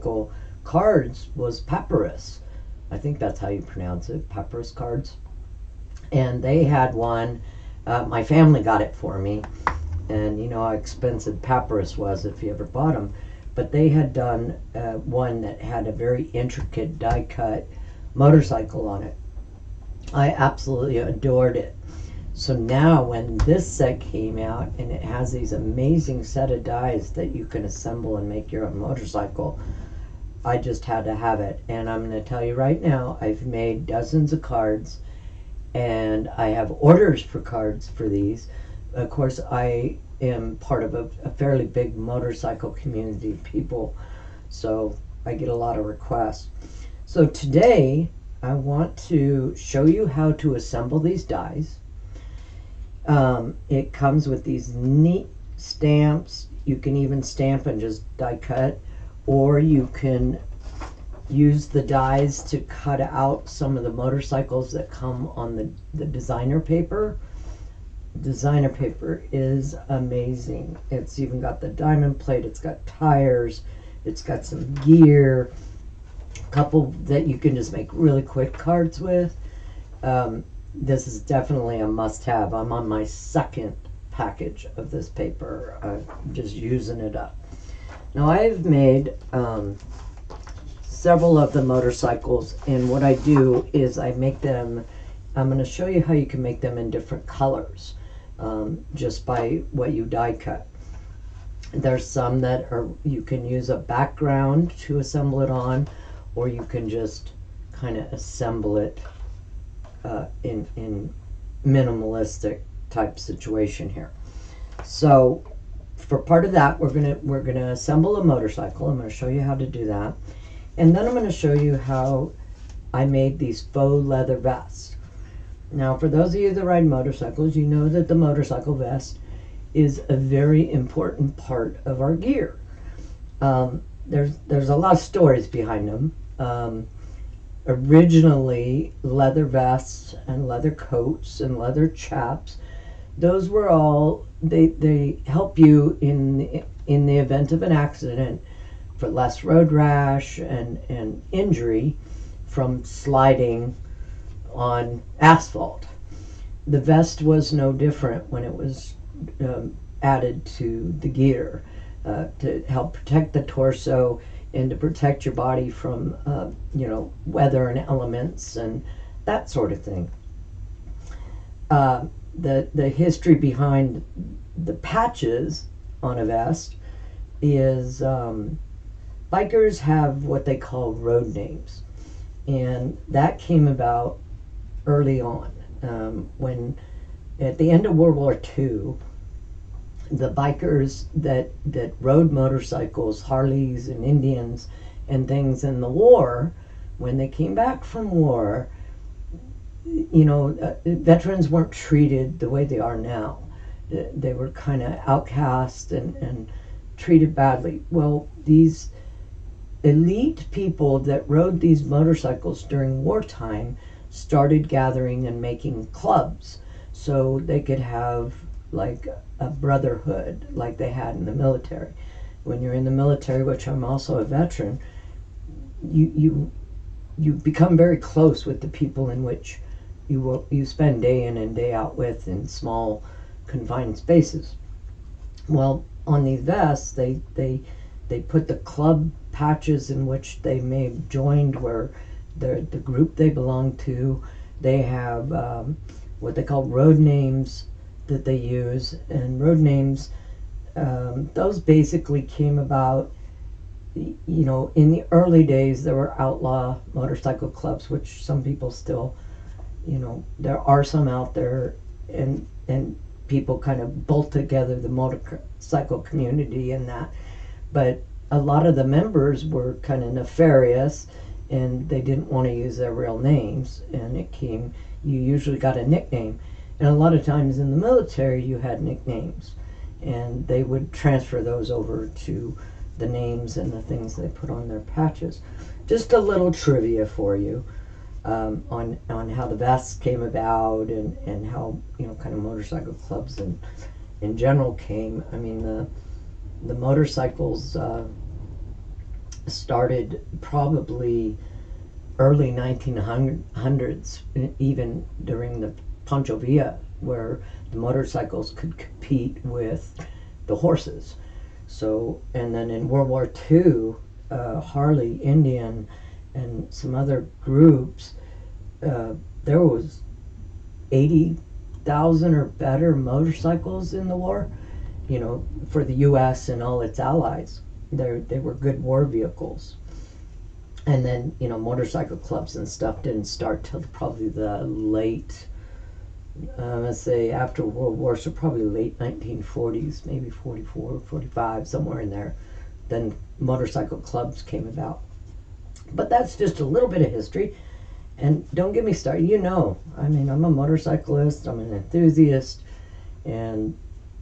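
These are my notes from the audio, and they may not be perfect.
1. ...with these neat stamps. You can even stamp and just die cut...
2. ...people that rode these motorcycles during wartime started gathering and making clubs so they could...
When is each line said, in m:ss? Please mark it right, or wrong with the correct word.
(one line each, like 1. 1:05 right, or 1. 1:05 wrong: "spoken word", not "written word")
1. 0:54 right
2. 3:30 right.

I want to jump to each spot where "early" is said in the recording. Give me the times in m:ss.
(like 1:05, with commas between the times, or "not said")
3:04, 4:15, 5:02.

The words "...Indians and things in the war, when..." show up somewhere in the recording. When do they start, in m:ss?
3:14.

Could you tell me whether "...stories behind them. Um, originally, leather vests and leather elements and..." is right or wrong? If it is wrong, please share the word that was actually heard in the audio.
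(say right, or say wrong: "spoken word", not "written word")
wrong: "coats", not "elements".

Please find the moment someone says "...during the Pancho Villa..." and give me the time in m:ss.
5:05.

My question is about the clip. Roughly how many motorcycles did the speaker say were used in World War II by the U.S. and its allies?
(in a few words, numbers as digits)
80,000.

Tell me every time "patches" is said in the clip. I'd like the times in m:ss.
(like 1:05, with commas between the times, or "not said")
2:54, 3:59, 4:44.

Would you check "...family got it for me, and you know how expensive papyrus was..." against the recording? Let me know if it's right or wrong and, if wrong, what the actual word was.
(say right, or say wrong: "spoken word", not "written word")
right.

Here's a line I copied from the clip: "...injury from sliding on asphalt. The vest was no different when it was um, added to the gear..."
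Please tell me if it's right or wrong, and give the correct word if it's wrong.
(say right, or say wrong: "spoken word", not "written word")
right.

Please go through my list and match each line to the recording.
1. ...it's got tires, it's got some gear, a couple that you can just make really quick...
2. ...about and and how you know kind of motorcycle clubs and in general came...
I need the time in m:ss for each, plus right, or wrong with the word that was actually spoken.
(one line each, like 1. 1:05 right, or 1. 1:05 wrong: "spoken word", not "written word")
1. 1:12 right
2. 4:50 right.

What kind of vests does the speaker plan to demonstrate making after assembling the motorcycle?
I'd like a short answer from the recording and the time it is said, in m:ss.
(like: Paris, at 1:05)
faux leather vests, at 2:03.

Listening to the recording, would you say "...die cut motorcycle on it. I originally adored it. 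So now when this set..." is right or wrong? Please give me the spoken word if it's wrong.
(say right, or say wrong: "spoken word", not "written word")
wrong: "absolutely", not "originally".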